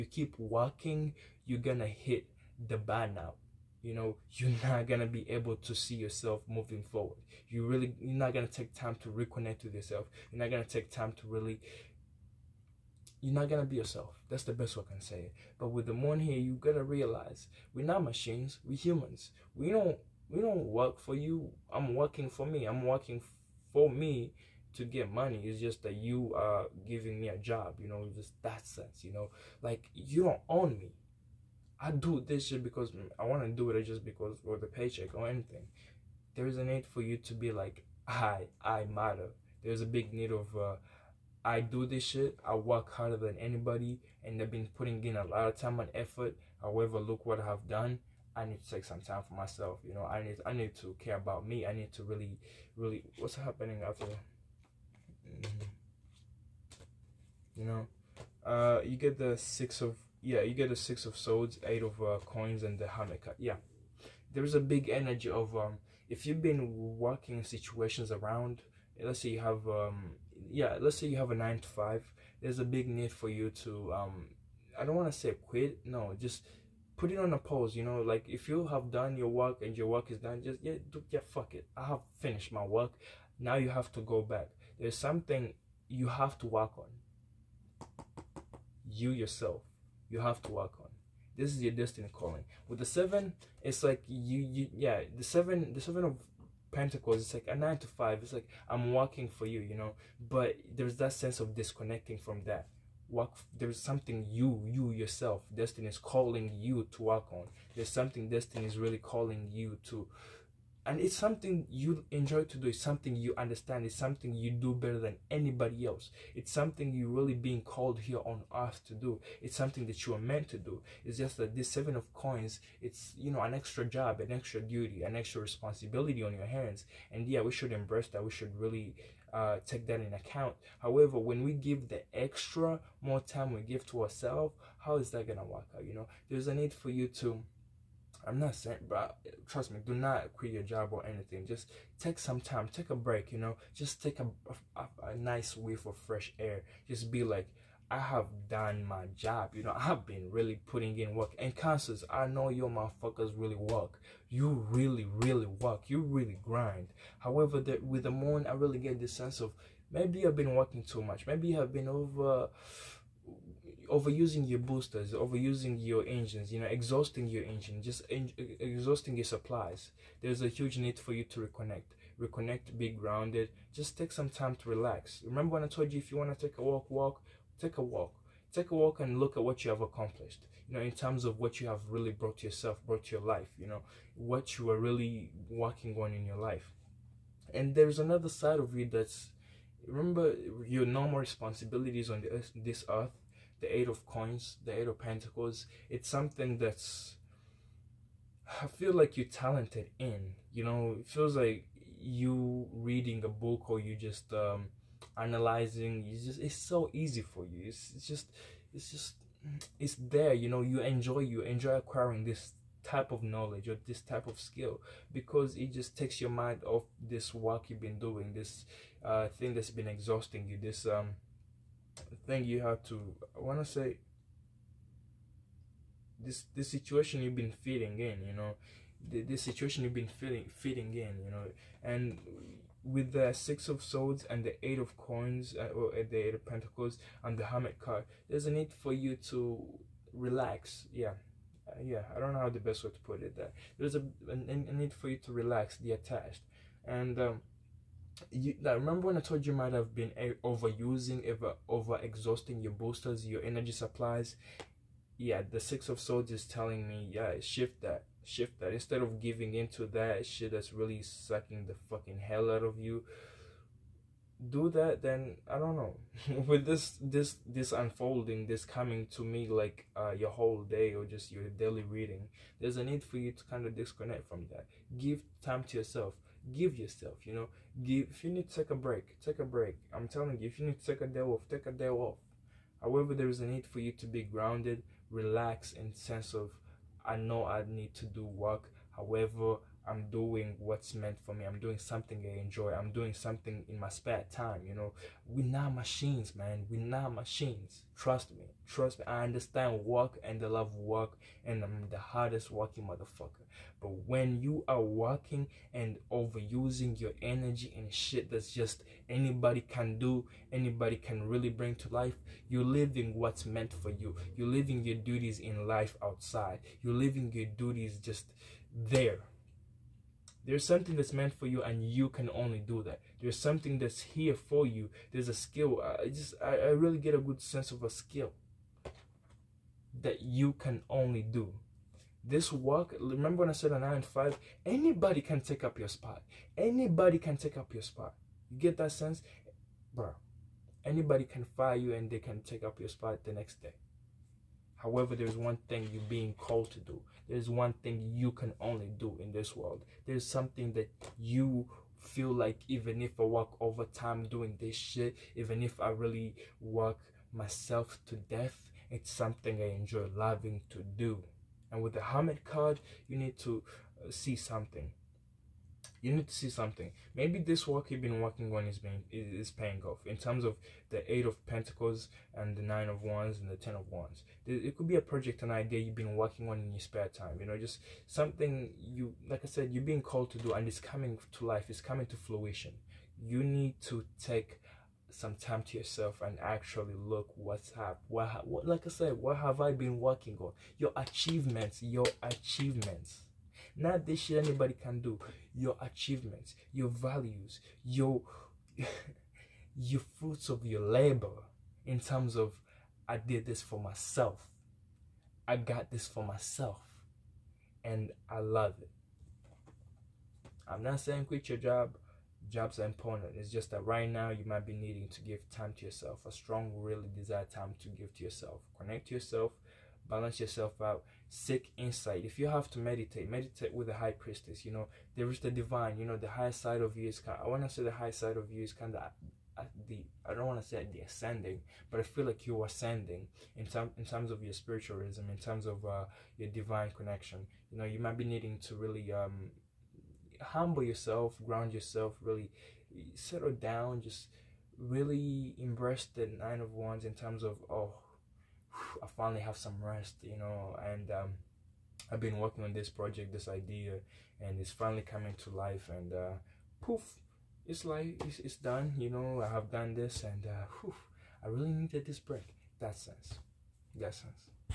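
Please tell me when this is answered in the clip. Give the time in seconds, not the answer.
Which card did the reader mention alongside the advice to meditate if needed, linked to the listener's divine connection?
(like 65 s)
423 s.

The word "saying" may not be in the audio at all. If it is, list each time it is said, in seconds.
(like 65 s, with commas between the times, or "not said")
138 s, 411 s.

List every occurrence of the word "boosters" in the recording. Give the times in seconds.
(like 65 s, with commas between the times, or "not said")
164 s, 252 s.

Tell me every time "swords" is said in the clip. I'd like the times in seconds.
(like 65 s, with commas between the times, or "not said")
61 s, 233 s, 255 s.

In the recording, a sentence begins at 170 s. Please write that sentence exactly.
There's a huge need for you to reconnect.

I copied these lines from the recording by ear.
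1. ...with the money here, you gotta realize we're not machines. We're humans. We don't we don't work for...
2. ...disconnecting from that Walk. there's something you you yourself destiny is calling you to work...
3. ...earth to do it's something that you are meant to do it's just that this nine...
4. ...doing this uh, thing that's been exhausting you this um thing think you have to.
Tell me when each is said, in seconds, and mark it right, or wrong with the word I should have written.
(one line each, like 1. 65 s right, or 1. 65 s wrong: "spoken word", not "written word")
1. 15 s right
2. 101 s right
3. 118 s wrong: "seven", not "nine"
4. 217 s right.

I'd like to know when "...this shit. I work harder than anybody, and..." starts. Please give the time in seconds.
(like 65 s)
41 s.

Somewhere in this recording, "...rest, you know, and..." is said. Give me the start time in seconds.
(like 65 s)
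449 s.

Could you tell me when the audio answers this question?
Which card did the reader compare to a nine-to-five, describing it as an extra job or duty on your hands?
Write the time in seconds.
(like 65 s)
95 s.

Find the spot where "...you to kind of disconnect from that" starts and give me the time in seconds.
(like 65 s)
273 s.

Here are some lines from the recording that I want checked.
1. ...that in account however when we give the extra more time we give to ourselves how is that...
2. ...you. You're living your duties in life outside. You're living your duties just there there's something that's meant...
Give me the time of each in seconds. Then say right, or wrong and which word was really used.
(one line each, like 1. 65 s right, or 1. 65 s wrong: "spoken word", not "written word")
1. 129 s right
2. 313 s right.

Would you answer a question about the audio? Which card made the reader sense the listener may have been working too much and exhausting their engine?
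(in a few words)
The moon.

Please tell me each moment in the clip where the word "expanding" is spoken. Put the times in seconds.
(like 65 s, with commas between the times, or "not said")
not said.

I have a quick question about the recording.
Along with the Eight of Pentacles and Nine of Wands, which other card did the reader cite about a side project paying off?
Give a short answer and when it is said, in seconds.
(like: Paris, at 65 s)
Ten of Wands, at 373 s.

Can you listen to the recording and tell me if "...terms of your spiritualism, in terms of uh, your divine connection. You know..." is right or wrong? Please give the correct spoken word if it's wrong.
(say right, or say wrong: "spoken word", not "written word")
right.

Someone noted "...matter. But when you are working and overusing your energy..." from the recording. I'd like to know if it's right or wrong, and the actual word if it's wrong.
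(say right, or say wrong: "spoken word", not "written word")
wrong: "motherfucker", not "matter".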